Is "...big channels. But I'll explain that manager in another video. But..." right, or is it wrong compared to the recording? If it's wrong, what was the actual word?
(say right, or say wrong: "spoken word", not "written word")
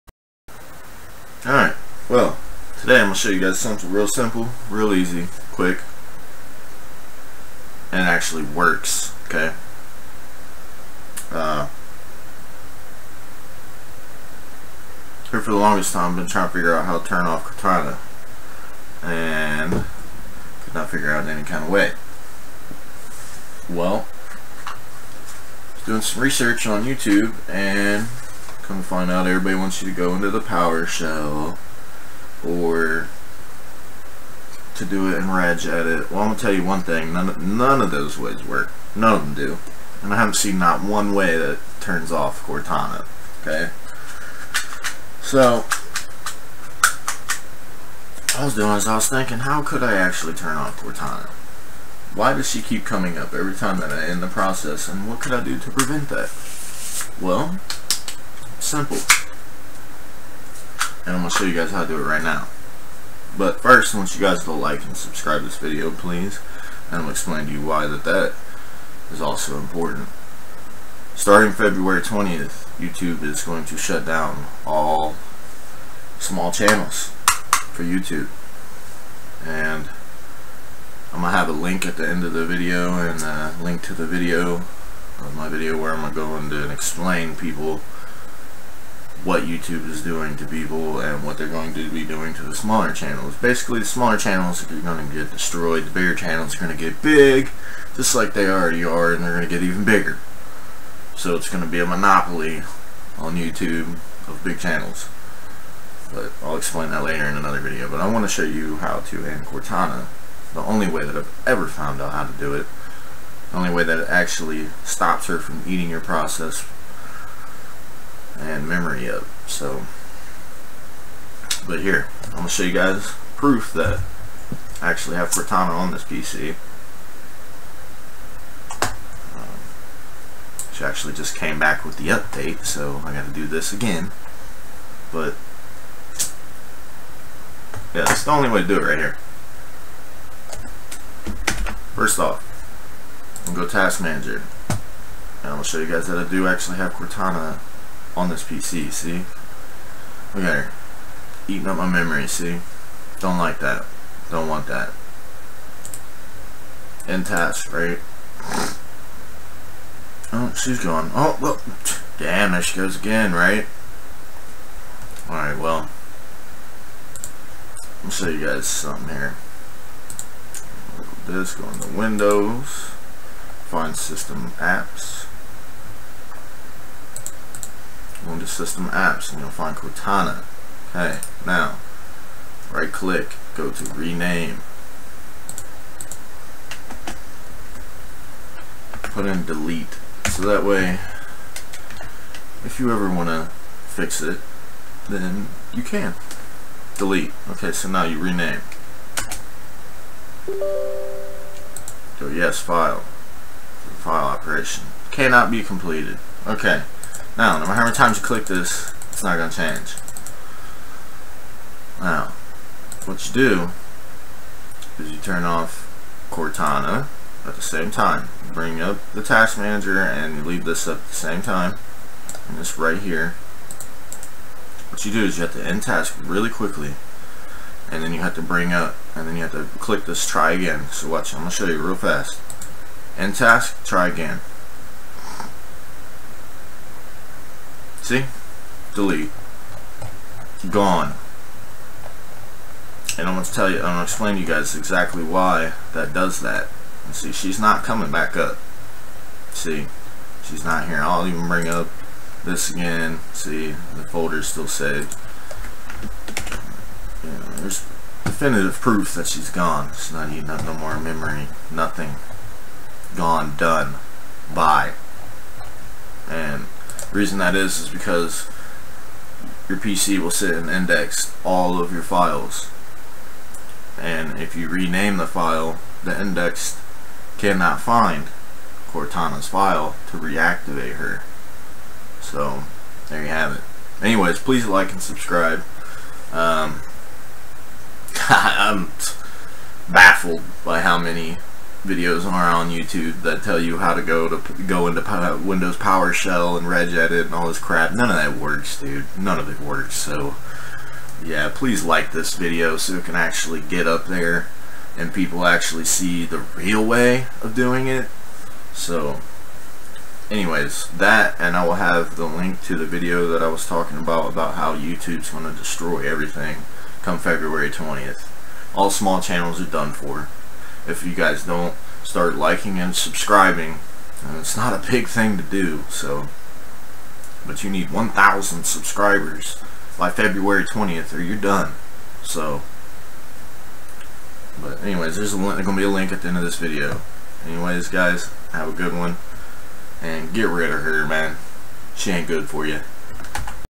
wrong: "later", not "manager".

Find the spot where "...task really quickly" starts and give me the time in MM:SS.
03:45.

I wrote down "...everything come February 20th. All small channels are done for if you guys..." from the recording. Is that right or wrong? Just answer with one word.
right.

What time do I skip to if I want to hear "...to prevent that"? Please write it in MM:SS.
00:55.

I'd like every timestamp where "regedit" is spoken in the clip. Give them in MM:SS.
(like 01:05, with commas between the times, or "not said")
00:35, 04:56.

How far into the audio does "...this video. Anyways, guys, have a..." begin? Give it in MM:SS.
05:36.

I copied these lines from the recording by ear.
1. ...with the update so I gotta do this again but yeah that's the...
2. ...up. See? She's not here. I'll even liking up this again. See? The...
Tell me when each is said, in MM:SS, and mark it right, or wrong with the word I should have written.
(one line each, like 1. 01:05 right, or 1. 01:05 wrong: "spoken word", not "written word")
1. 02:11 right
2. 04:08 wrong: "bring", not "liking".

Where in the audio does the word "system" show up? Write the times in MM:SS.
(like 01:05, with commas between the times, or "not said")
02:53, 02:58.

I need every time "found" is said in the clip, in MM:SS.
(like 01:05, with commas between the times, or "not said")
01:51.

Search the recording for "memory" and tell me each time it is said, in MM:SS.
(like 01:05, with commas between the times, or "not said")
01:58, 02:31, 04:20.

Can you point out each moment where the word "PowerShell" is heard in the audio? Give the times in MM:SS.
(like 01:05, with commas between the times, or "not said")
00:30, 04:55.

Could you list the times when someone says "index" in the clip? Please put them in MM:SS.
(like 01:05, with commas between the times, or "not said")
04:30, 04:36.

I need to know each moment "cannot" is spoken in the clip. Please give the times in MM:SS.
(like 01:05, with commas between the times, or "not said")
03:25, 04:37.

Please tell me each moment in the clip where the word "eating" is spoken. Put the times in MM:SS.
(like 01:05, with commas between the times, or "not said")
01:55, 02:31.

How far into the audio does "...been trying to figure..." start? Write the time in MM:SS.
00:16.